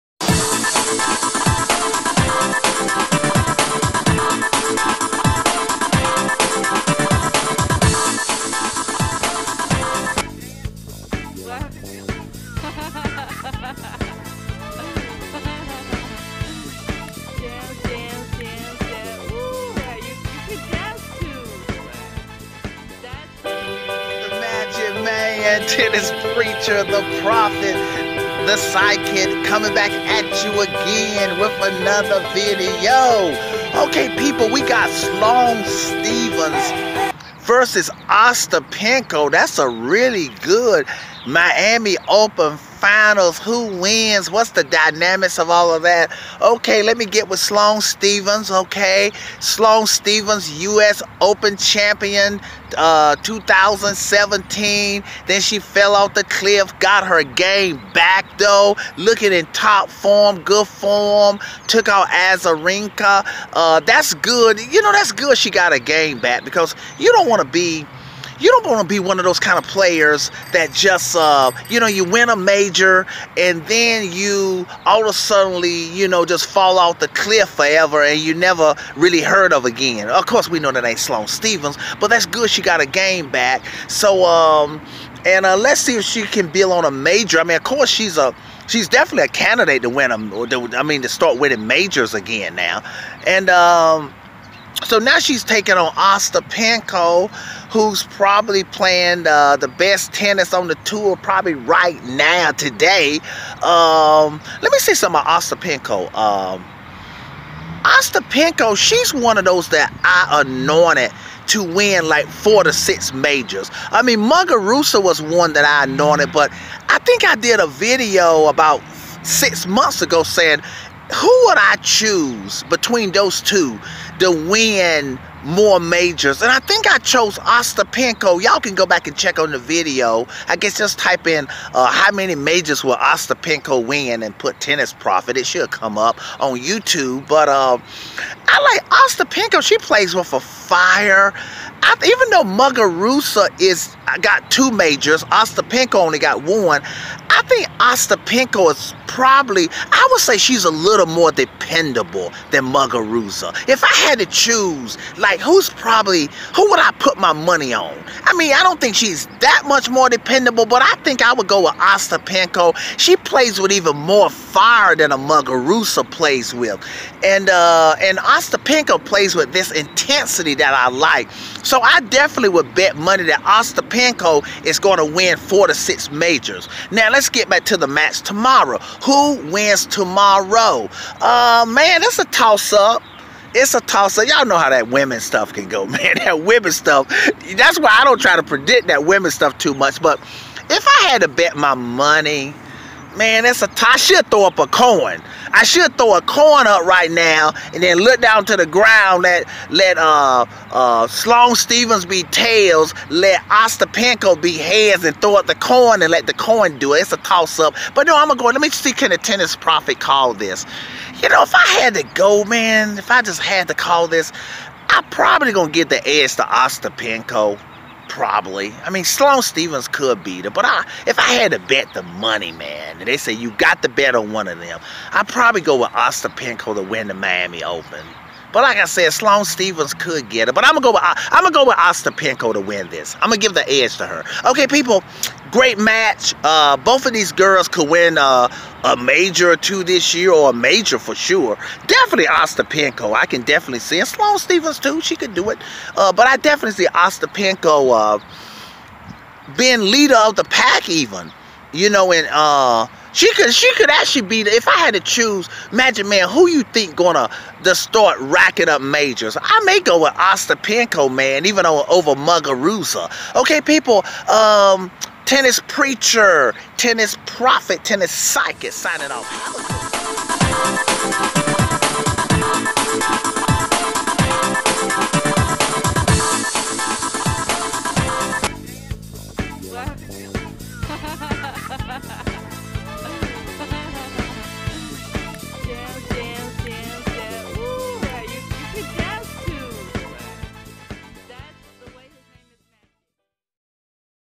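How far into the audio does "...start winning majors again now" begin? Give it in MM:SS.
01:31.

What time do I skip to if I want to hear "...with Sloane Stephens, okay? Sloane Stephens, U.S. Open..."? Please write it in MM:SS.
00:47.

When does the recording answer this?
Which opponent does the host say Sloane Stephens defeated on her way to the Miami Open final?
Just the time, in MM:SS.
01:02.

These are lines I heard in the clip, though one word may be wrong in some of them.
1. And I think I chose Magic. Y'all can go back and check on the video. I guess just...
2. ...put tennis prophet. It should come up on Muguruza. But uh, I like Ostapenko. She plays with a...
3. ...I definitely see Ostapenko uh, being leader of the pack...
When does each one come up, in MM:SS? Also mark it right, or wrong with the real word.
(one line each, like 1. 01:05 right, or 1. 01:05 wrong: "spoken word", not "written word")
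1. 02:06 wrong: "Ostapenko", not "Magic"
2. 02:14 wrong: "YouTube", not "Muguruza"
3. 04:06 right.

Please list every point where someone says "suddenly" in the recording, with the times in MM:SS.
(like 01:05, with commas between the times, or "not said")
01:15.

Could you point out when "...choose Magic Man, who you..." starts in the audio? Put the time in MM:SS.
04:15.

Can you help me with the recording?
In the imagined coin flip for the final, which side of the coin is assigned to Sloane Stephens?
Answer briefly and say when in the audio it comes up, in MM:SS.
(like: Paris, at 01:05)
Tails, at 03:22.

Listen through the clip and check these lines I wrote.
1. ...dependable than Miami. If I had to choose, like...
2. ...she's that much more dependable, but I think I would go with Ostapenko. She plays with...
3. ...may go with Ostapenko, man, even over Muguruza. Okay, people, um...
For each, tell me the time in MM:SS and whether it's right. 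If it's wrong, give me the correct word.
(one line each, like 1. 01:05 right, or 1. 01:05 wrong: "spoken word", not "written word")
1. 02:31 wrong: "Muguruza", not "Miami"
2. 02:38 right
3. 04:19 right.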